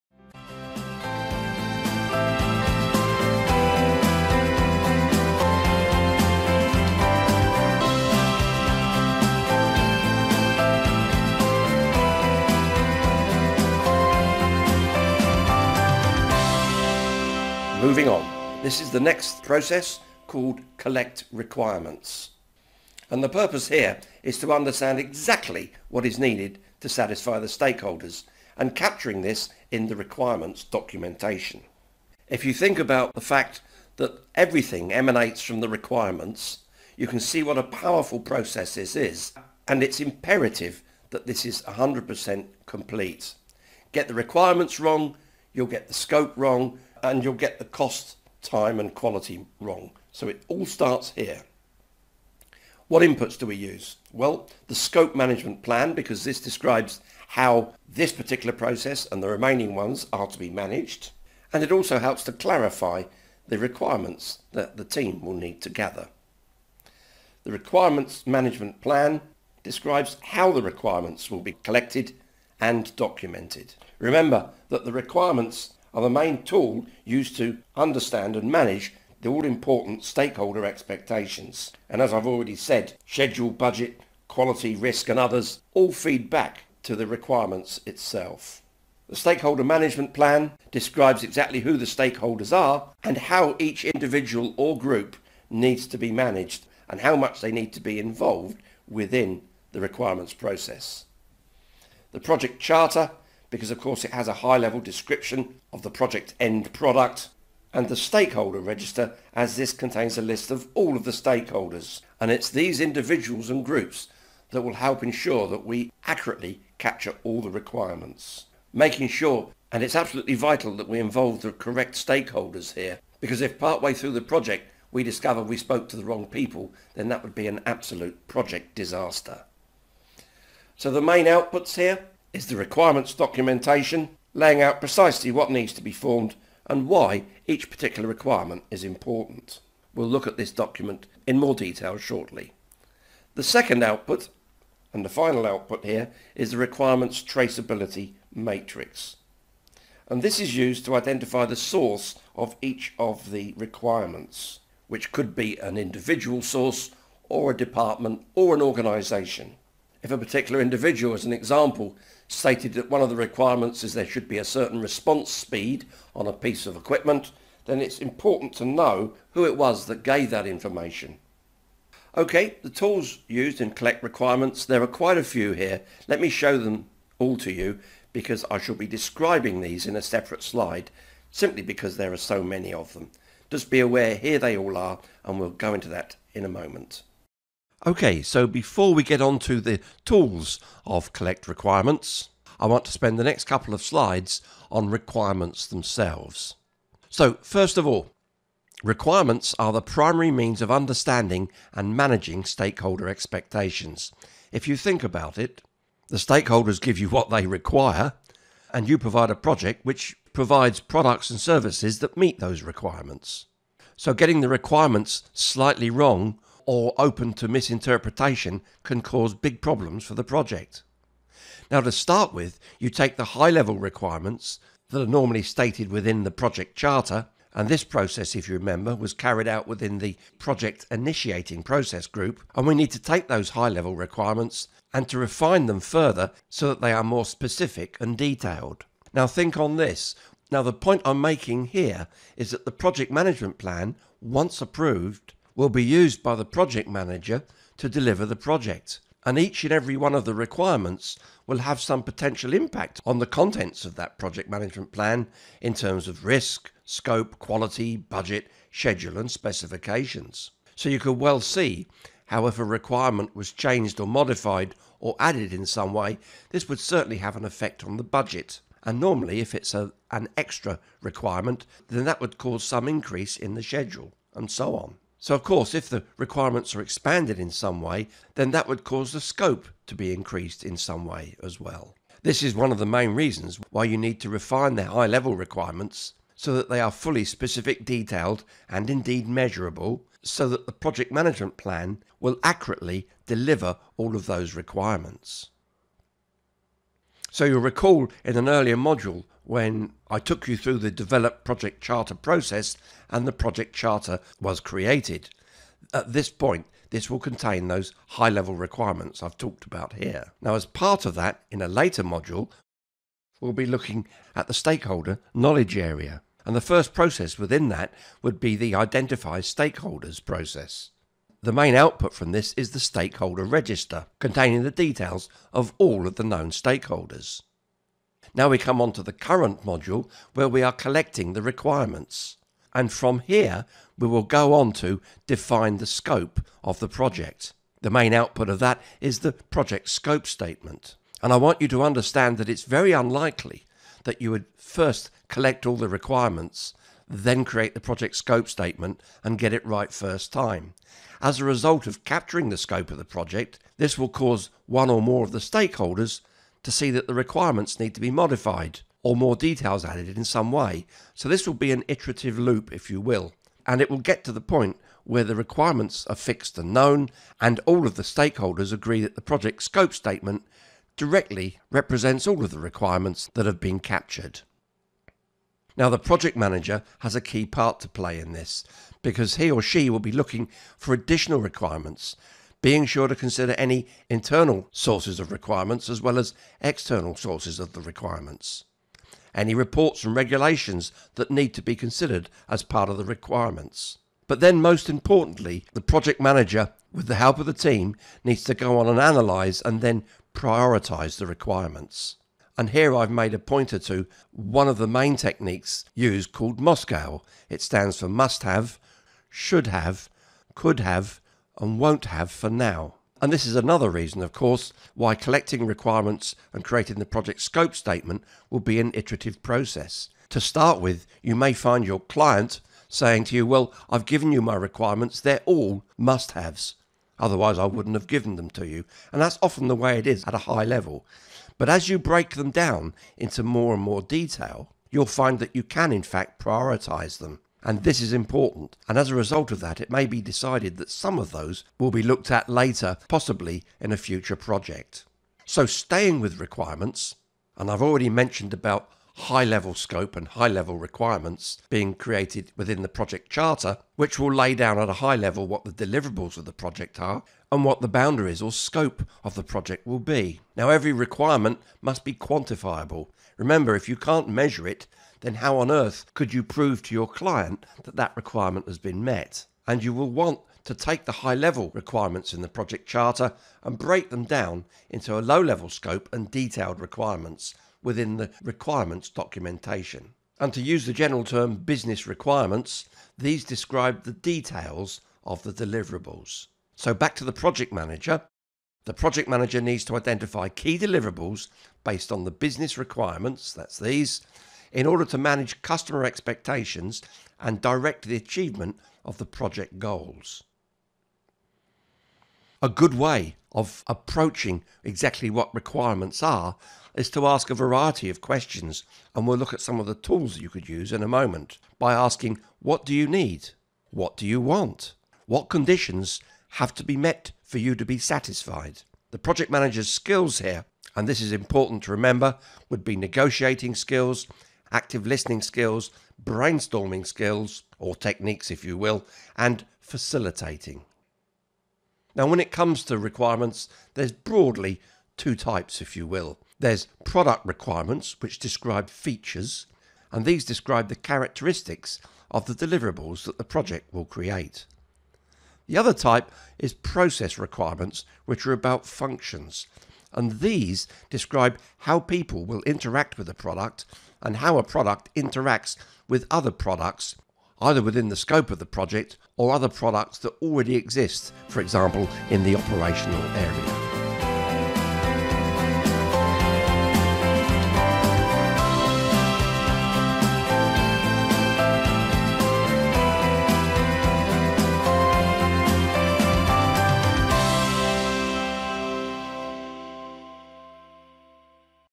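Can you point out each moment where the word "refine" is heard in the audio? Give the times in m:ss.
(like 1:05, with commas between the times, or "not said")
3:55, 4:44.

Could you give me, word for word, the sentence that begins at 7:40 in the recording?
Now, every requirement must be quantifiable.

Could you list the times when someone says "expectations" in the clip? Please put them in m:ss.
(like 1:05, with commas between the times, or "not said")
1:20, 3:23, 8:16.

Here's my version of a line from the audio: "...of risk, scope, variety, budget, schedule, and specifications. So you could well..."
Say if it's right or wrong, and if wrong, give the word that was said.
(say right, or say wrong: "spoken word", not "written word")
wrong: "quality", not "variety".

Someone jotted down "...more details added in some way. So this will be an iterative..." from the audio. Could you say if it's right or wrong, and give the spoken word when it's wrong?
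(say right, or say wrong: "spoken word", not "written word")
right.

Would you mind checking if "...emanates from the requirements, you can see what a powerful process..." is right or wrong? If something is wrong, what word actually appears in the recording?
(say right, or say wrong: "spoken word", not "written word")
right.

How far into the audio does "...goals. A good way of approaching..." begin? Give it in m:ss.
8:19.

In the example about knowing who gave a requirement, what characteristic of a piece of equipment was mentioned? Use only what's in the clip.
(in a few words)
Response speed.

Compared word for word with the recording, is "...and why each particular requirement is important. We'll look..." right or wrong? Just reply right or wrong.
right.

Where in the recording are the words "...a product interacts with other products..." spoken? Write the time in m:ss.
9:14.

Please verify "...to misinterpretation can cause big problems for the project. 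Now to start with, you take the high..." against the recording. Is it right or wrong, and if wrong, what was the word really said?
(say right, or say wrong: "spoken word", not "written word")
right.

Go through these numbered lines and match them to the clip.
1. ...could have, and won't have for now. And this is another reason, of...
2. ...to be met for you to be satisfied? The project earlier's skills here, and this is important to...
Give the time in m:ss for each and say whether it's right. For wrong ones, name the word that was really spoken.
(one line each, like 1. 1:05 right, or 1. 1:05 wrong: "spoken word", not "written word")
1. 6:50 right
2. 8:36 wrong: "manager", not "earlier".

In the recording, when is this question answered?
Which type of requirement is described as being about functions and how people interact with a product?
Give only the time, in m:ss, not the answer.
9:06.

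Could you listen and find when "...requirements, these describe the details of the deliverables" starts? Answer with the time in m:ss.
8:02.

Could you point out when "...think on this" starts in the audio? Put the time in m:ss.
3:59.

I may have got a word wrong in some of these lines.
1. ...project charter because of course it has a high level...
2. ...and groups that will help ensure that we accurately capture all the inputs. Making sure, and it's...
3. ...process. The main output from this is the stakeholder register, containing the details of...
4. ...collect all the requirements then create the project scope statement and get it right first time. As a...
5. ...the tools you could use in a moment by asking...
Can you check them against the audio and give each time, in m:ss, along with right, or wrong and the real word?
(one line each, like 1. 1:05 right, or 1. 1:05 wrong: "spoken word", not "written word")
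1. 1:42 right
2. 1:53 wrong: "requirements", not "inputs"
3. 5:20 right
4. 5:45 right
5. 8:29 right.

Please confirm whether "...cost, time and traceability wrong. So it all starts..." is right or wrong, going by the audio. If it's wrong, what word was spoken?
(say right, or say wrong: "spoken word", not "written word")
wrong: "quality", not "traceability".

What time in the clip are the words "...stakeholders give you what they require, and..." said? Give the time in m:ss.
3:26.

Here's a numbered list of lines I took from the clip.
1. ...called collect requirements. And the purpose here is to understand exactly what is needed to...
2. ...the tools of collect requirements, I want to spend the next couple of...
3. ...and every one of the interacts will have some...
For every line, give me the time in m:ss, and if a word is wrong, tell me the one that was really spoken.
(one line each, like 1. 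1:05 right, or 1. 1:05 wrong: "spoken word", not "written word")
1. 0:20 right
2. 3:09 right
3. 4:09 wrong: "requirements", not "interacts".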